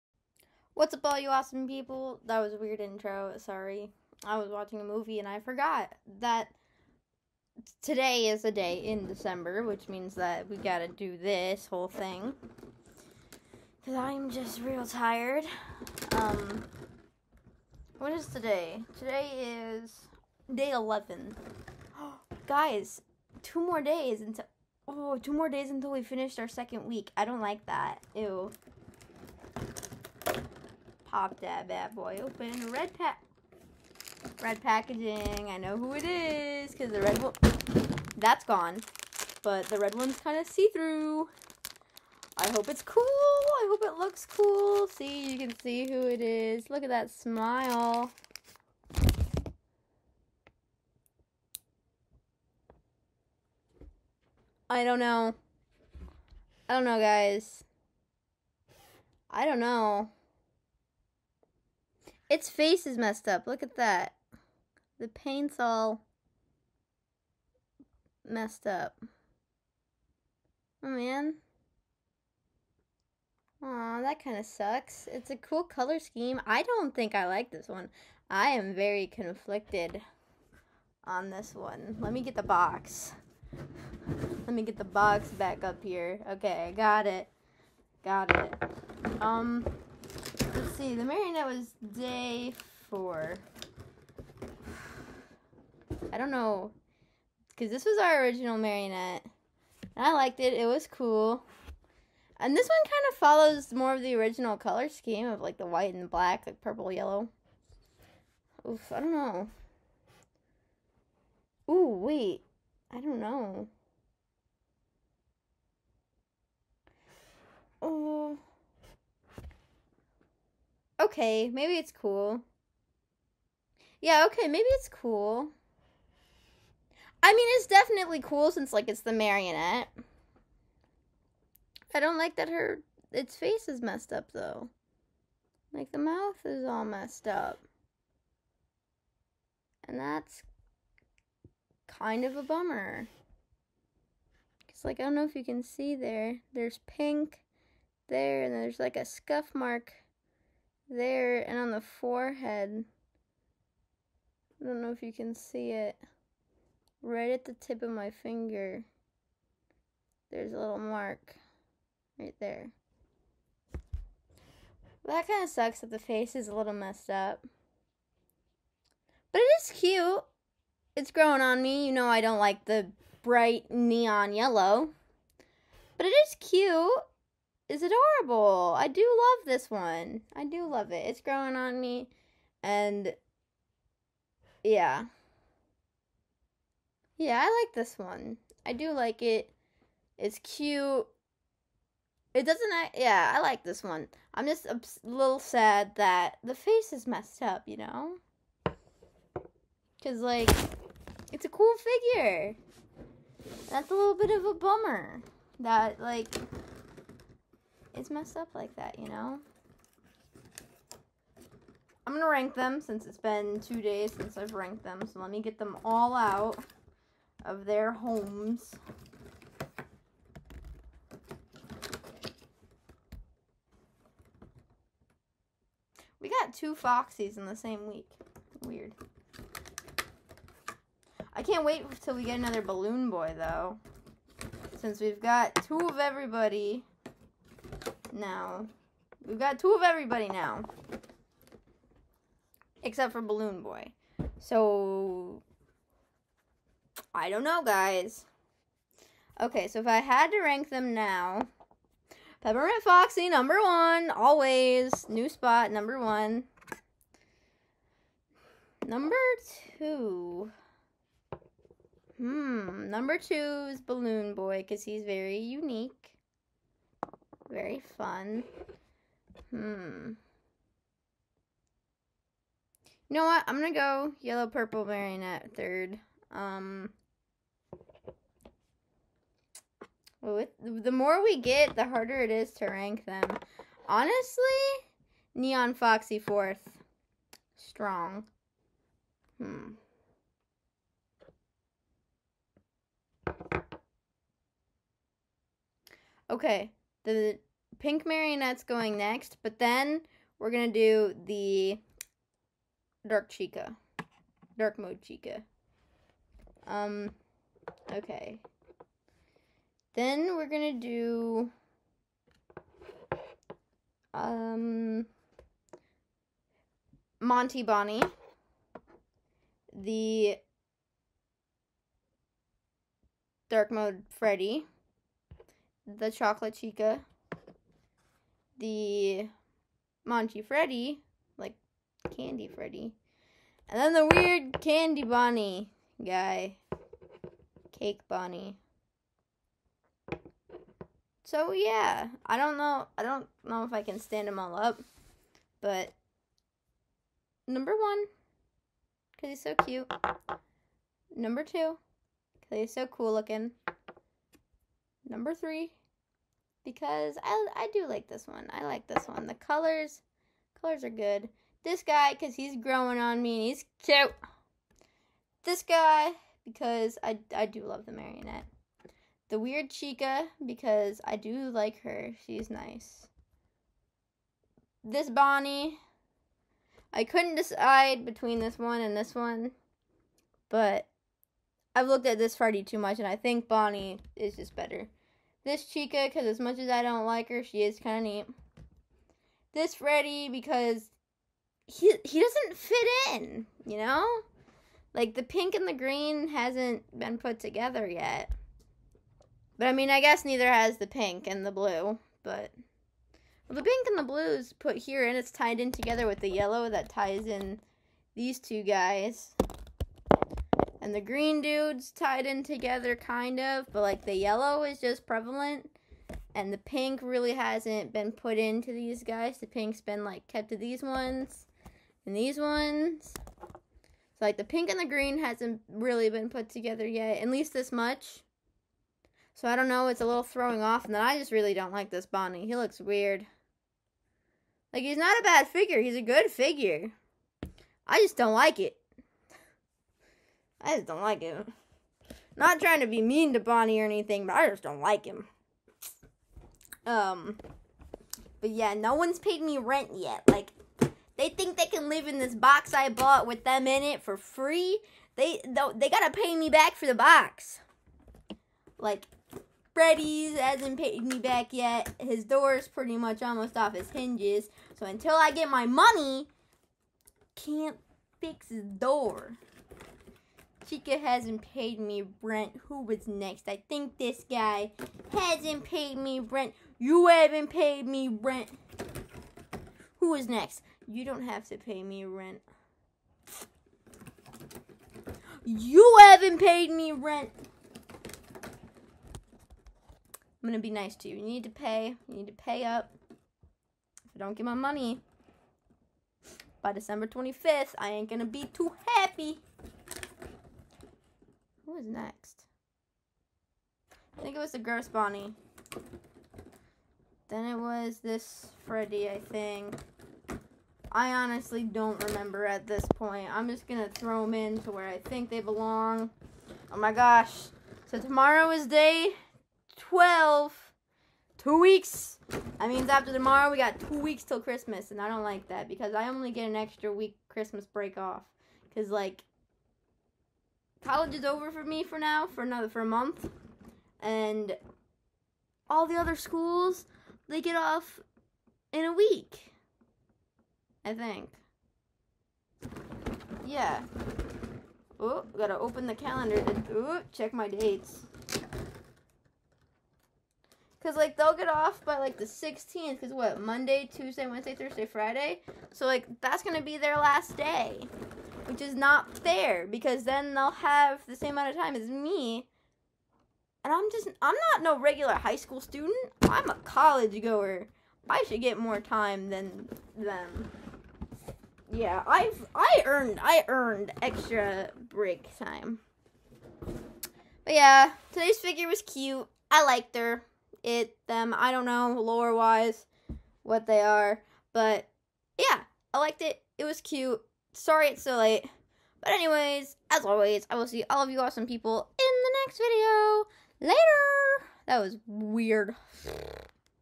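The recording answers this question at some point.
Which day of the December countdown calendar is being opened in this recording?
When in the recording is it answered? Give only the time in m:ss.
0:18.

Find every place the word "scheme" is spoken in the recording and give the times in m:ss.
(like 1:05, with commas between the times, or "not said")
1:15, 1:44.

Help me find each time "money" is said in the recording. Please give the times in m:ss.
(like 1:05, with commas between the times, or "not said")
7:45, 8:14.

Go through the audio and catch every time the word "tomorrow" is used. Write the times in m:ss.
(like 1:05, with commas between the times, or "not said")
8:37, 8:43.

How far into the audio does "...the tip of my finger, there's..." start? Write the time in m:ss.
2:37.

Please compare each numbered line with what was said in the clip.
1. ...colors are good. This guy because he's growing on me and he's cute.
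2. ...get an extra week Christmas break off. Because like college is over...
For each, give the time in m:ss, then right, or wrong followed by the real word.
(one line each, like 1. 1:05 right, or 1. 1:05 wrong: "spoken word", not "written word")
1. 6:00 right
2. 8:46 right.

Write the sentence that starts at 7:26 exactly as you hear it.
Um, but yeah, no one's paid me rent yet.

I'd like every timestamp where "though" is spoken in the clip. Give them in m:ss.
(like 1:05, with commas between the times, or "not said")
2:14, 3:53.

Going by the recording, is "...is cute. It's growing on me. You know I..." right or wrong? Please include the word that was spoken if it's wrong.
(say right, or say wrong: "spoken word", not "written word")
right.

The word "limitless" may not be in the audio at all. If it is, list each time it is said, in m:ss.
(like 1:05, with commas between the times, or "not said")
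not said.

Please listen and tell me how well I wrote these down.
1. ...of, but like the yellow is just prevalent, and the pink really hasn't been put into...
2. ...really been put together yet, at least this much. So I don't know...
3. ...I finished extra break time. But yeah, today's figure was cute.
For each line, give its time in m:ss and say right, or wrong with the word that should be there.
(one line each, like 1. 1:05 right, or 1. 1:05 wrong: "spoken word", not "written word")
1. 6:53 right
2. 7:05 right
3. 9:33 wrong: "earned", not "finished".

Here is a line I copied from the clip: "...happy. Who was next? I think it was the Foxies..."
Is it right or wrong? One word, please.
wrong.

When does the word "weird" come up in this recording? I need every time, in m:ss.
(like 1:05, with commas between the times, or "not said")
0:02, 3:48, 5:34, 6:09, 7:12, 9:55.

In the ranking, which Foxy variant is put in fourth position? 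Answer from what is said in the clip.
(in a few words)
Neon Foxy.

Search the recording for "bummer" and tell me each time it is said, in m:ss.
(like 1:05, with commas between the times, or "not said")
2:22, 3:24.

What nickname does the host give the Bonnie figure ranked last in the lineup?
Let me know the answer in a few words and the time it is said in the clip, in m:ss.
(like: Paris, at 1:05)
Cake Bonnie, at 5:37.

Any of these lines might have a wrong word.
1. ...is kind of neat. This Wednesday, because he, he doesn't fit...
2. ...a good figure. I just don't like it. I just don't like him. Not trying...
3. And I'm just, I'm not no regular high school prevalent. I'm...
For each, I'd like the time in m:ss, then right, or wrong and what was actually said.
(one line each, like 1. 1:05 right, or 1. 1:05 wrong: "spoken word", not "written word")
1. 6:27 wrong: "Freddy", not "Wednesday"
2. 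7:15 right
3. 9:23 wrong: "student", not "prevalent".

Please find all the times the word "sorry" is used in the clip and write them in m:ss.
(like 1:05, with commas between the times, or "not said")
0:03, 9:47.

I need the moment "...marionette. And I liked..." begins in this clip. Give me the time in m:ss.
1:38.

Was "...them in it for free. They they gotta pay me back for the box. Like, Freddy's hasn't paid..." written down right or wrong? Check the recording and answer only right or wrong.
right.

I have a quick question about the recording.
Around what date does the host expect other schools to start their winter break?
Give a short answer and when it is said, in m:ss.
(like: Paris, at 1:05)
the 16th, at 9:12.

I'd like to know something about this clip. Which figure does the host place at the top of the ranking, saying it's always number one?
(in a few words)
Peppermint Foxy.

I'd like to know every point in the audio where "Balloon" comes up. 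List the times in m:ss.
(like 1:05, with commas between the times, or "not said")
3:52, 4:03, 4:23.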